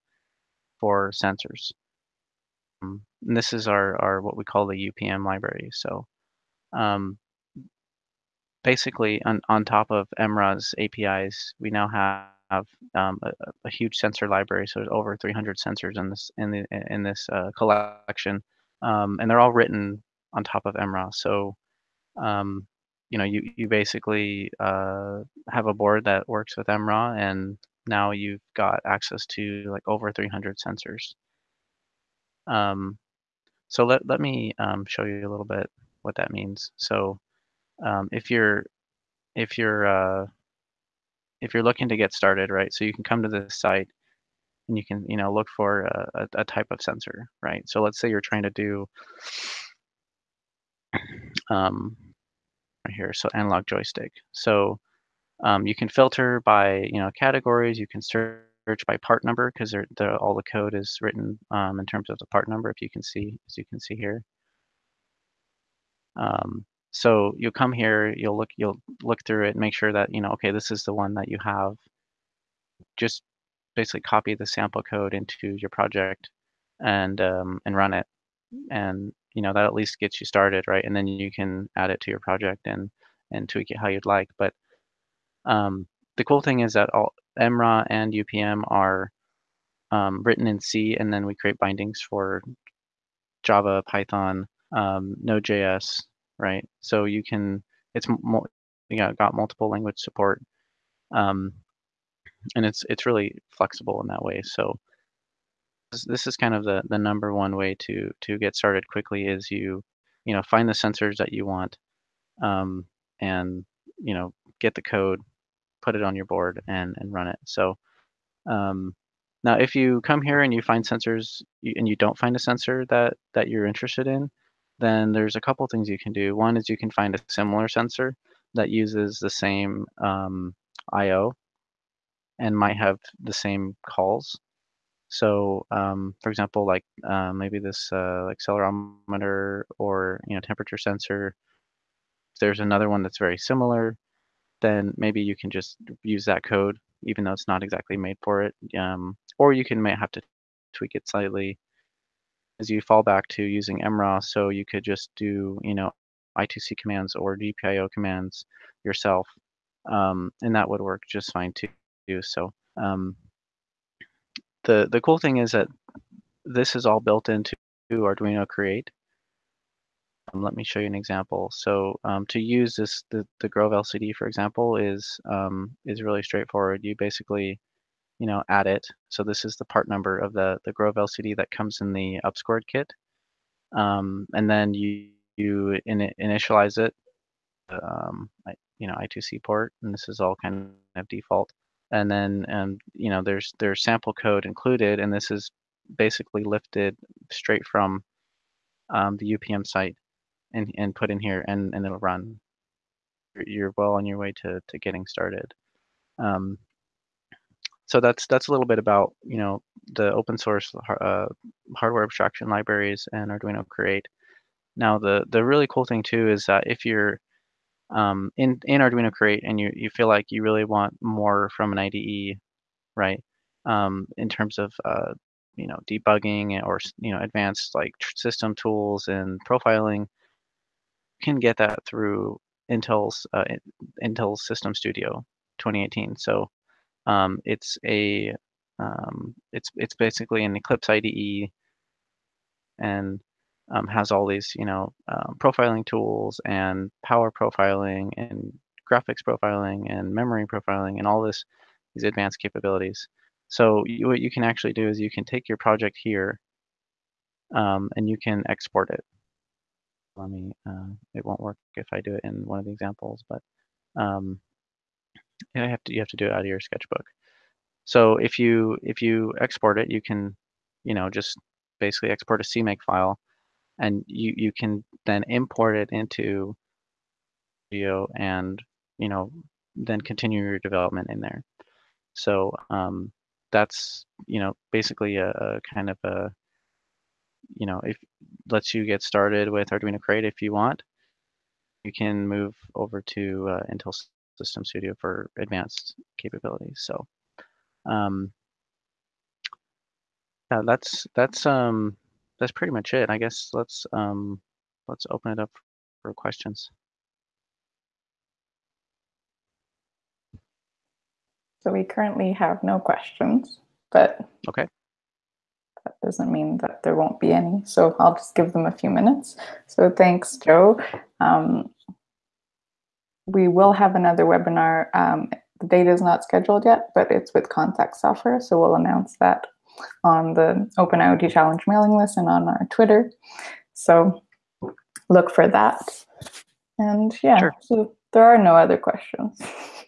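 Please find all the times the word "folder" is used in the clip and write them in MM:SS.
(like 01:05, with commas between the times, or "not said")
not said.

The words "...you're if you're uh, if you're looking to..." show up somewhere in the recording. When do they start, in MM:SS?
00:38.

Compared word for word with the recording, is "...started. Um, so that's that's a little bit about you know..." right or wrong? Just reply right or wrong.
right.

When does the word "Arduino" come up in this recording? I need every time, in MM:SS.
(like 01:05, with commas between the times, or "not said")
02:47, 03:33, 03:38, 04:49.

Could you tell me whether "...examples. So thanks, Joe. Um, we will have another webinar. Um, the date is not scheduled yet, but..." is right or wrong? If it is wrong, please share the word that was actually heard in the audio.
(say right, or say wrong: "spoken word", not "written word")
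wrong: "minutes", not "examples".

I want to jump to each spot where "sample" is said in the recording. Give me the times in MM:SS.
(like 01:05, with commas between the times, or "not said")
01:14, 03:13.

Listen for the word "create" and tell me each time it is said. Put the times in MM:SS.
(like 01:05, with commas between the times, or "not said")
01:31, 02:48, 03:33, 03:39, 04:49.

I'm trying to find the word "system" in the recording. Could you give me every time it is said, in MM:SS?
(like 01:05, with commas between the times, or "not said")
03:48, 03:54, 04:54.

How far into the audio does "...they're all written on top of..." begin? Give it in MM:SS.
00:19.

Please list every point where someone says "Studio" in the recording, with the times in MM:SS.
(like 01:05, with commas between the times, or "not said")
03:54, 04:37, 04:54.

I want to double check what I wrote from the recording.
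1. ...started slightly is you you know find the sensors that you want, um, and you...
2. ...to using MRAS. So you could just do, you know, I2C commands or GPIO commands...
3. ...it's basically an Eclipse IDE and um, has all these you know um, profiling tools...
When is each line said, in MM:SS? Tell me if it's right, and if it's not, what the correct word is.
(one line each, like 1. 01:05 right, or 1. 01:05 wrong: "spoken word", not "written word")
1. 01:48 wrong: "quickly", not "slightly"
2. 02:33 right
3. 03:59 right.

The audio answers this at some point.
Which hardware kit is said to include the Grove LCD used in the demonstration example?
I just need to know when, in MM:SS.
03:02.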